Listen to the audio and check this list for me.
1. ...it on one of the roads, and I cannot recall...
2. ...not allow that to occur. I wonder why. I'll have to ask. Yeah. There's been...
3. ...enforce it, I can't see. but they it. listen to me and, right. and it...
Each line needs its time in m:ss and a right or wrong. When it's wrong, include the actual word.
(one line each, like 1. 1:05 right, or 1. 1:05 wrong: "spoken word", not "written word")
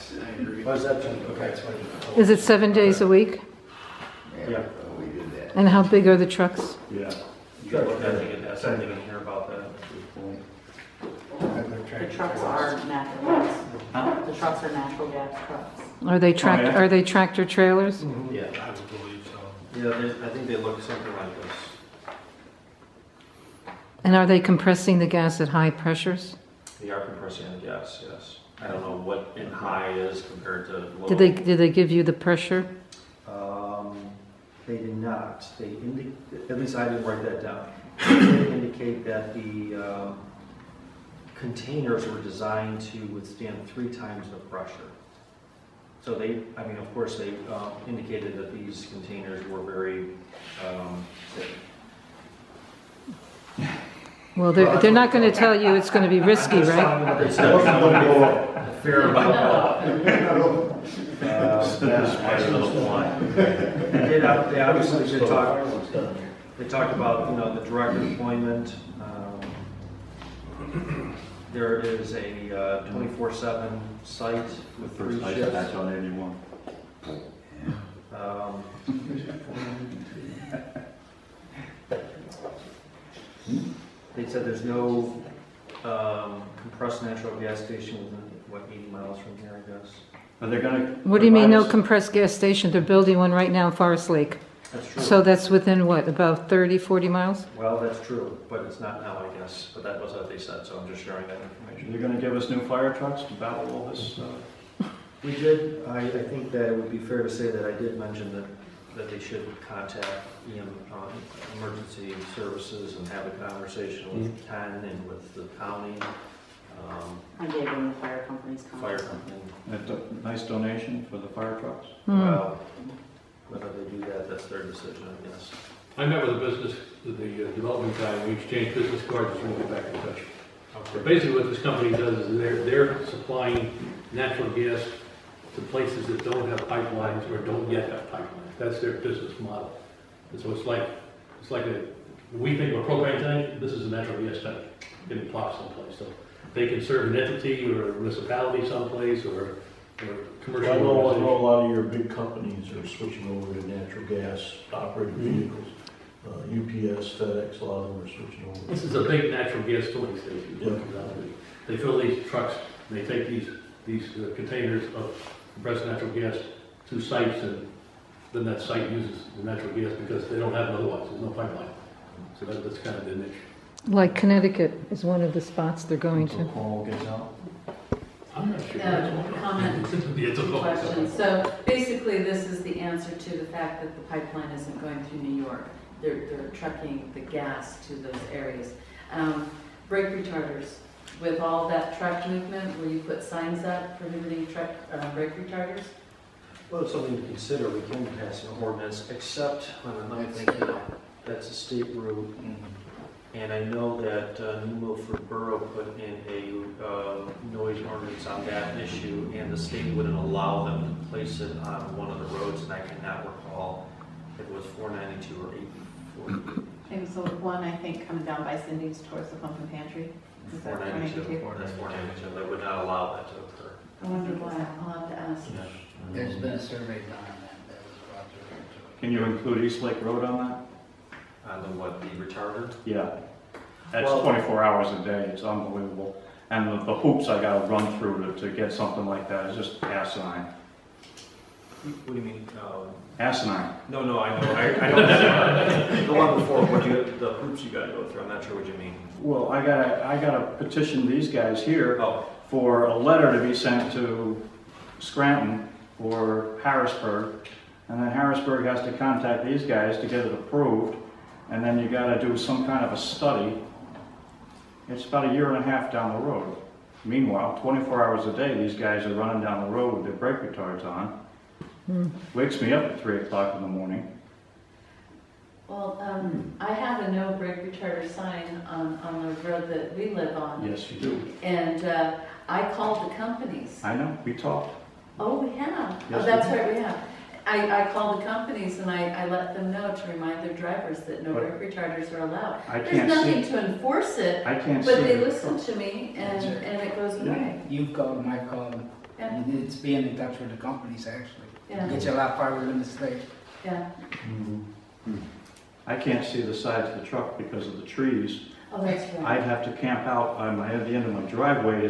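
1. 3:31 right
2. 3:42 right
3. 4:53 right.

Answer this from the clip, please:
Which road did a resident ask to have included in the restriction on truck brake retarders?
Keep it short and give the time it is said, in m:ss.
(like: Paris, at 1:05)
East Lake Road, at 3:49.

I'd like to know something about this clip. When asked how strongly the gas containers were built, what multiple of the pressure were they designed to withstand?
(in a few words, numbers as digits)
3 times.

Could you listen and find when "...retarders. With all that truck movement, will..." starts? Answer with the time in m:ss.
3:10.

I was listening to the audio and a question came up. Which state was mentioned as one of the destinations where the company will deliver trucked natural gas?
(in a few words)
Connecticut.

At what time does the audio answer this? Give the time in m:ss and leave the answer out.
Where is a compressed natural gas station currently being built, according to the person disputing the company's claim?
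1:33.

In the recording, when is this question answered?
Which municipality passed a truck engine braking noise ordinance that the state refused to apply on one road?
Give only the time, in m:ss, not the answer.
3:24.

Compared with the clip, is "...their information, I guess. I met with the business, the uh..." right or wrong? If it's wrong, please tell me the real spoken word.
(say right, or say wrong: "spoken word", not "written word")
wrong: "decision", not "information".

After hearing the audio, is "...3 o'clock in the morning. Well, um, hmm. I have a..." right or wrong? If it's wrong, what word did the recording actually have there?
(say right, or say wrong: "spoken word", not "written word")
right.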